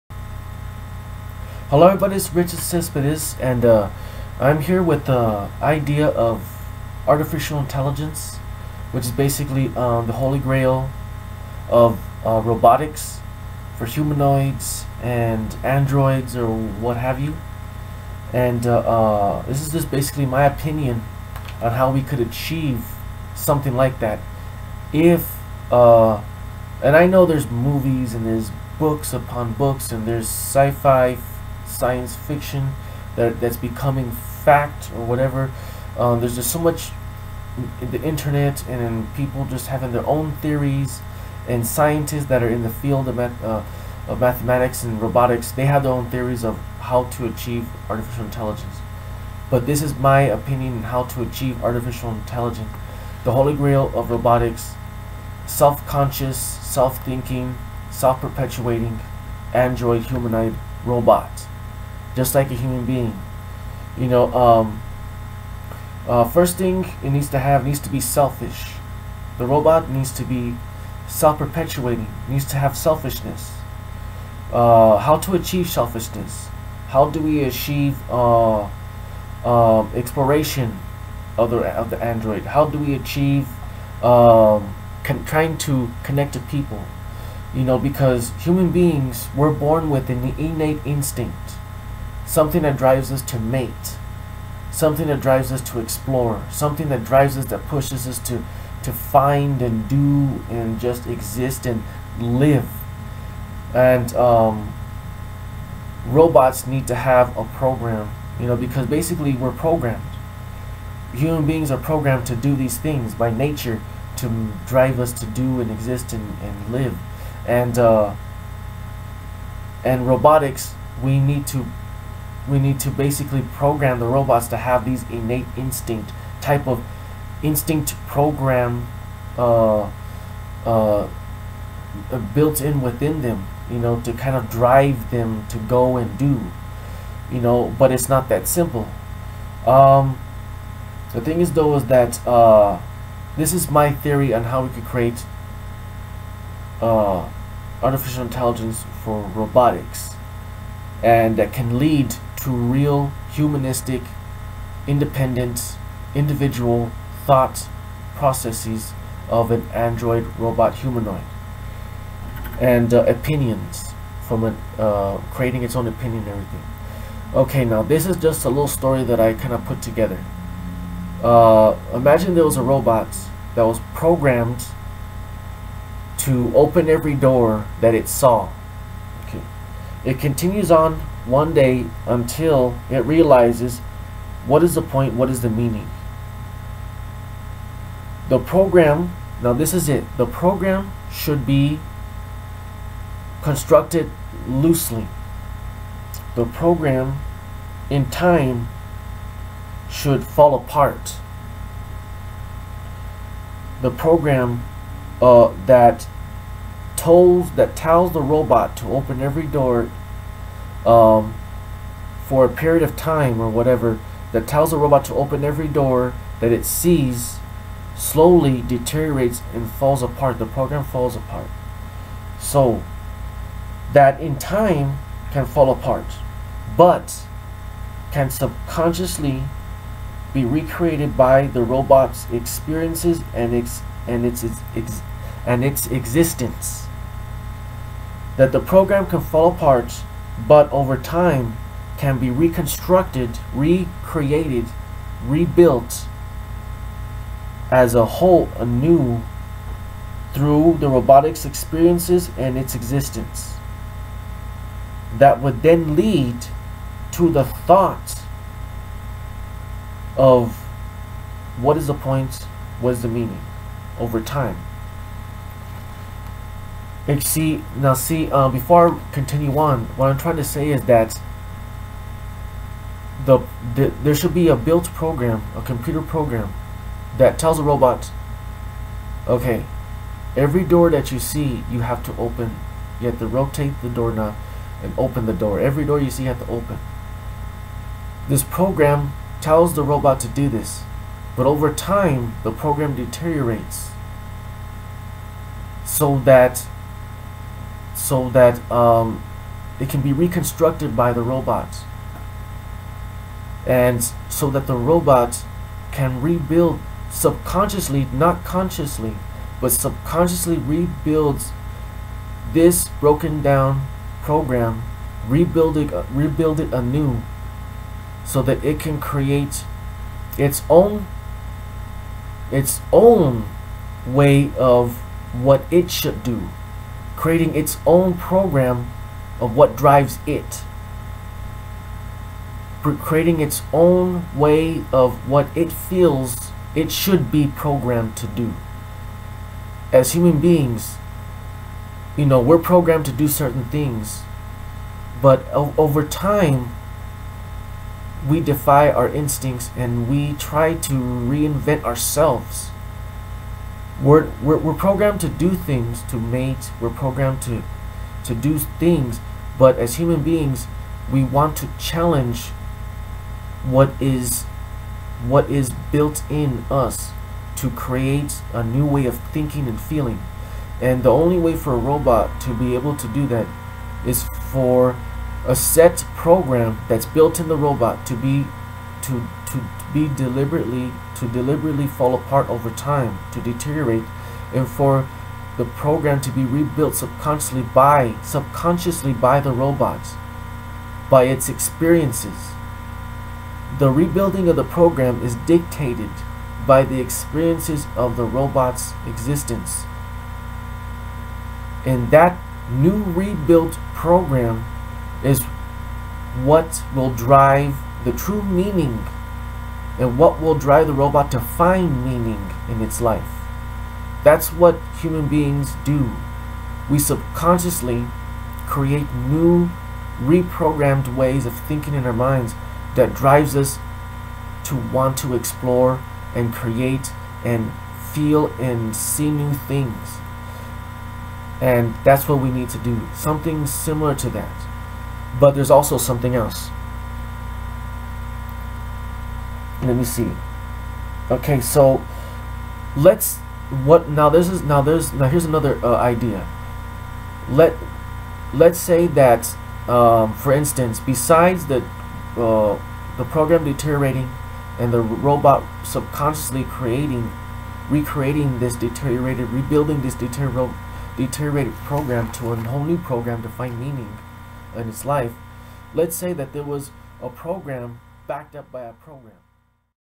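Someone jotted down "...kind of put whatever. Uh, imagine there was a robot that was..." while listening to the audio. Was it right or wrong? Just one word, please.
wrong.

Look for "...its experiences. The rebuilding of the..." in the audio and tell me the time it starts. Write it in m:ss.
6:31.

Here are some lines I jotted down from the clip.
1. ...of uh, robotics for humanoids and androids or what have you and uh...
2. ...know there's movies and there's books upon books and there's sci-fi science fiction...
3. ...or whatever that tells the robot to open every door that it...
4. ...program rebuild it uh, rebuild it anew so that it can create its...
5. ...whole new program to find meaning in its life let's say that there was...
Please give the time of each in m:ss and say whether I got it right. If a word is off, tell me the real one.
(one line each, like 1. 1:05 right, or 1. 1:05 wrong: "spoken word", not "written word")
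1. 0:11 right
2. 0:27 right
3. 3:33 right
4. 5:14 right
5. 7:42 right.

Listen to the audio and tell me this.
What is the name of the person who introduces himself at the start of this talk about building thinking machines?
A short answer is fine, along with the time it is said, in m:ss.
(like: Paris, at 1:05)
Richard Cespedes, at 0:02.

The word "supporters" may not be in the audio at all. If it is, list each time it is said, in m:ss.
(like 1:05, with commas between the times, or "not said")
not said.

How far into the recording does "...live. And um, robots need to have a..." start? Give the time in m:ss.
1:42.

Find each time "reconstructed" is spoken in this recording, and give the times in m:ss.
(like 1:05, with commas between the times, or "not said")
4:02, 5:00.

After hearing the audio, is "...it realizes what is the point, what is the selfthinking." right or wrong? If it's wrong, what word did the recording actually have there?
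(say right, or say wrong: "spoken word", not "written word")
wrong: "meaning", not "selfthinking".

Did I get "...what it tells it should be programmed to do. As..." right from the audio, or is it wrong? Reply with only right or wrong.
wrong.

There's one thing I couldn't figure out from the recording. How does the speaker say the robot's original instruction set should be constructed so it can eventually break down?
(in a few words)
Loosely.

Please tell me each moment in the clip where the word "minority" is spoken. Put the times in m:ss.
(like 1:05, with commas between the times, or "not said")
not said.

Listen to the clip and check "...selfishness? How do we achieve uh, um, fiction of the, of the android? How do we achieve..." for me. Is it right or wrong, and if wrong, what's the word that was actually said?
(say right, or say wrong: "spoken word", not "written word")
wrong: "exploration", not "fiction".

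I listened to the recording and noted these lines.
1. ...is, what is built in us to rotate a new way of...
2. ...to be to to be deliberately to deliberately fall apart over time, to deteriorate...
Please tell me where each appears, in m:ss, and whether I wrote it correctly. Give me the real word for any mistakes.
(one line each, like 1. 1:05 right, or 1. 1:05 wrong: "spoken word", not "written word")
1. 6:04 wrong: "create", not "rotate"
2. 6:18 right.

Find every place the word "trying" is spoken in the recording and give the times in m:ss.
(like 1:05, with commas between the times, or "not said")
1:25, 4:30.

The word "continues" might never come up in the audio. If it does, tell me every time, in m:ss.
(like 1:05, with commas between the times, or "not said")
3:00, 4:29.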